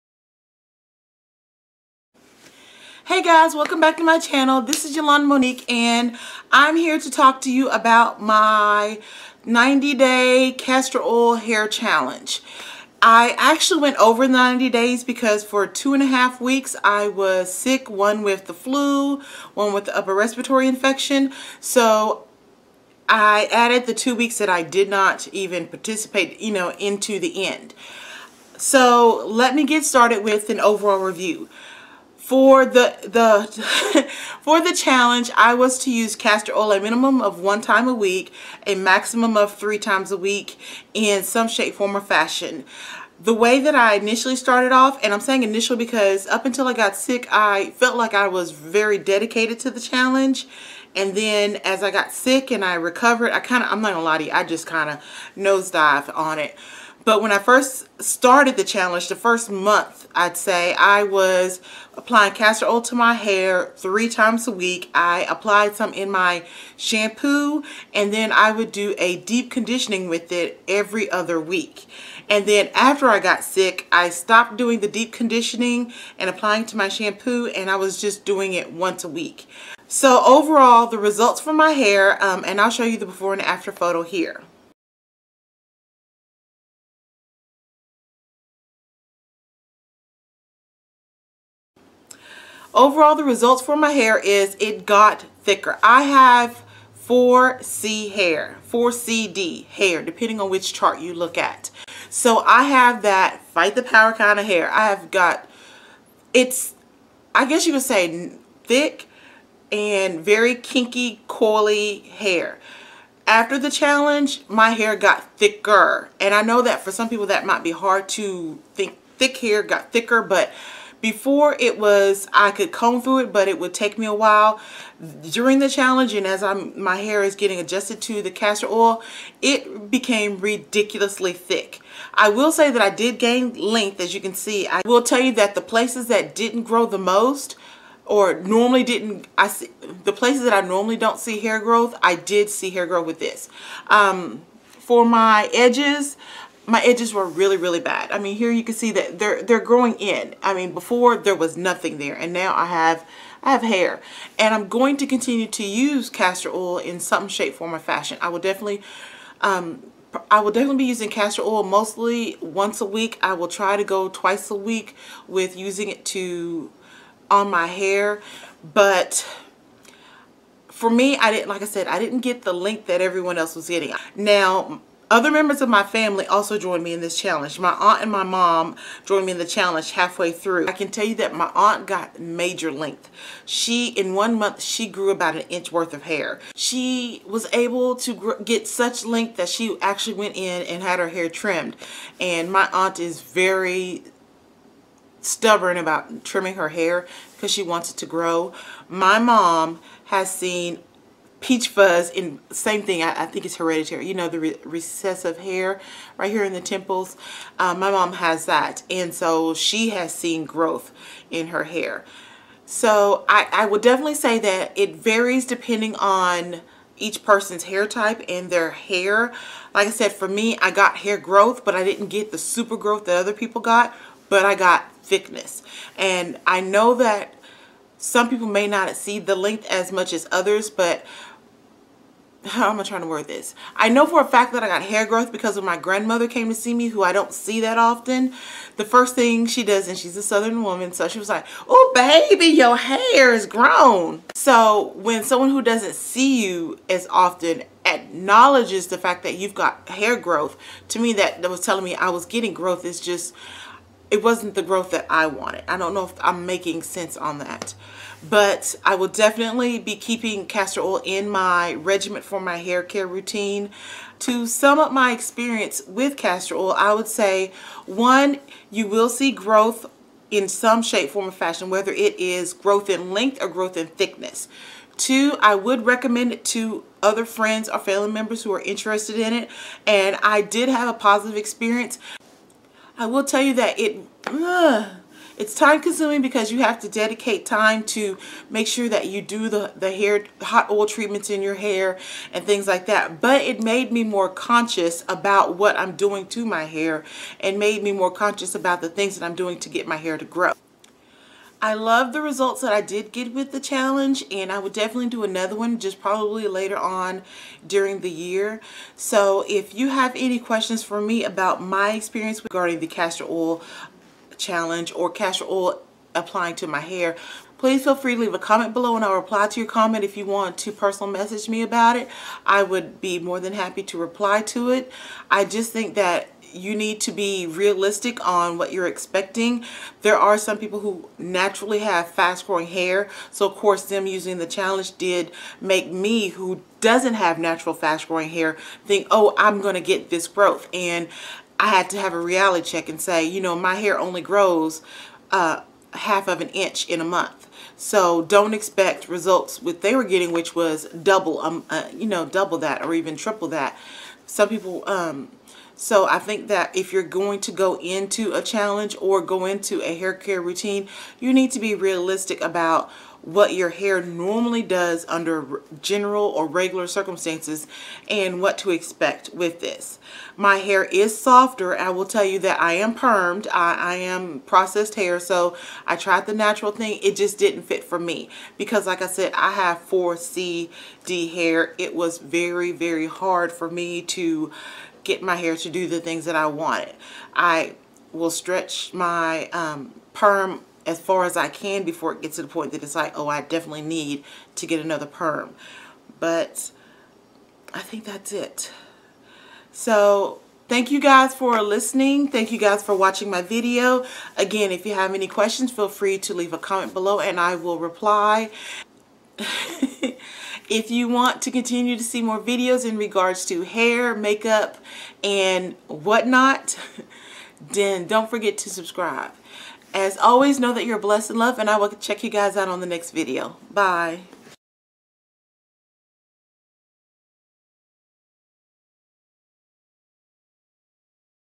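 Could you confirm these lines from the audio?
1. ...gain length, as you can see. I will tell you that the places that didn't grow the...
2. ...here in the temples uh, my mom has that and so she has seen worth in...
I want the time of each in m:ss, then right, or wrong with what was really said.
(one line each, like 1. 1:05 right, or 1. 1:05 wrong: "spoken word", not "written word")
1. 2:13 right
2. 3:26 wrong: "growth", not "worth".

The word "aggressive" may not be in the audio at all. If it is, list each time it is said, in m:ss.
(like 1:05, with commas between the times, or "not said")
not said.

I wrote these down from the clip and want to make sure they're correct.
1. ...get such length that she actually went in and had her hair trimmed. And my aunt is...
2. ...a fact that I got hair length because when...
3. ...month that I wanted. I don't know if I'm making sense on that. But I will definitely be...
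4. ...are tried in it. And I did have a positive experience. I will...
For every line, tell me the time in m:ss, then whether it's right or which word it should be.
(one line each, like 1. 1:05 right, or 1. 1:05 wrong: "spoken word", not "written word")
1. 3:08 right
2. 3:54 wrong: "growth", not "length"
3. 4:14 wrong: "growth", not "month"
4. 4:38 wrong: "interested", not "tried".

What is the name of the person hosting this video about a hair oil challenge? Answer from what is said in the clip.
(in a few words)
Yolanda Monique.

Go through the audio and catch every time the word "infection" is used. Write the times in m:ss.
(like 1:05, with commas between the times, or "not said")
0:20.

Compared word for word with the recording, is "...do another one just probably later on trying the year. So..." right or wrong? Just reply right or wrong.
wrong.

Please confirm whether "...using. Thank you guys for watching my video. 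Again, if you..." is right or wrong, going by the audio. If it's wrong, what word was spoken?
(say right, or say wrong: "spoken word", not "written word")
wrong: "listening", not "using".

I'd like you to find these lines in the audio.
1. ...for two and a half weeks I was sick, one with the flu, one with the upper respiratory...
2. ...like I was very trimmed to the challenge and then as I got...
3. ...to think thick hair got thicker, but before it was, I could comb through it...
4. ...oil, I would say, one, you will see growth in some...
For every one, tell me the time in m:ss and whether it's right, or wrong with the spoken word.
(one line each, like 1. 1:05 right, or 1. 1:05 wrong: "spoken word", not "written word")
1. 0:15 right
2. 0:47 wrong: "dedicated", not "trimmed"
3. 1:58 right
4. 4:26 right.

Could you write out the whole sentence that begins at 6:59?
As always, know that you're blessed and loved, and I will check you guys out on the next video.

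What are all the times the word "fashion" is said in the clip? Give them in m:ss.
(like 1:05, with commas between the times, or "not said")
0:41, 2:37, 4:31.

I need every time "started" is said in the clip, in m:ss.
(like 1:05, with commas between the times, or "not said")
0:29, 0:44, 0:58.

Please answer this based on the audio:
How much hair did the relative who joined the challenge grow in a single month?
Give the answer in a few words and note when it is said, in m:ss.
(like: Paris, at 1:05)
About an inch, at 3:05.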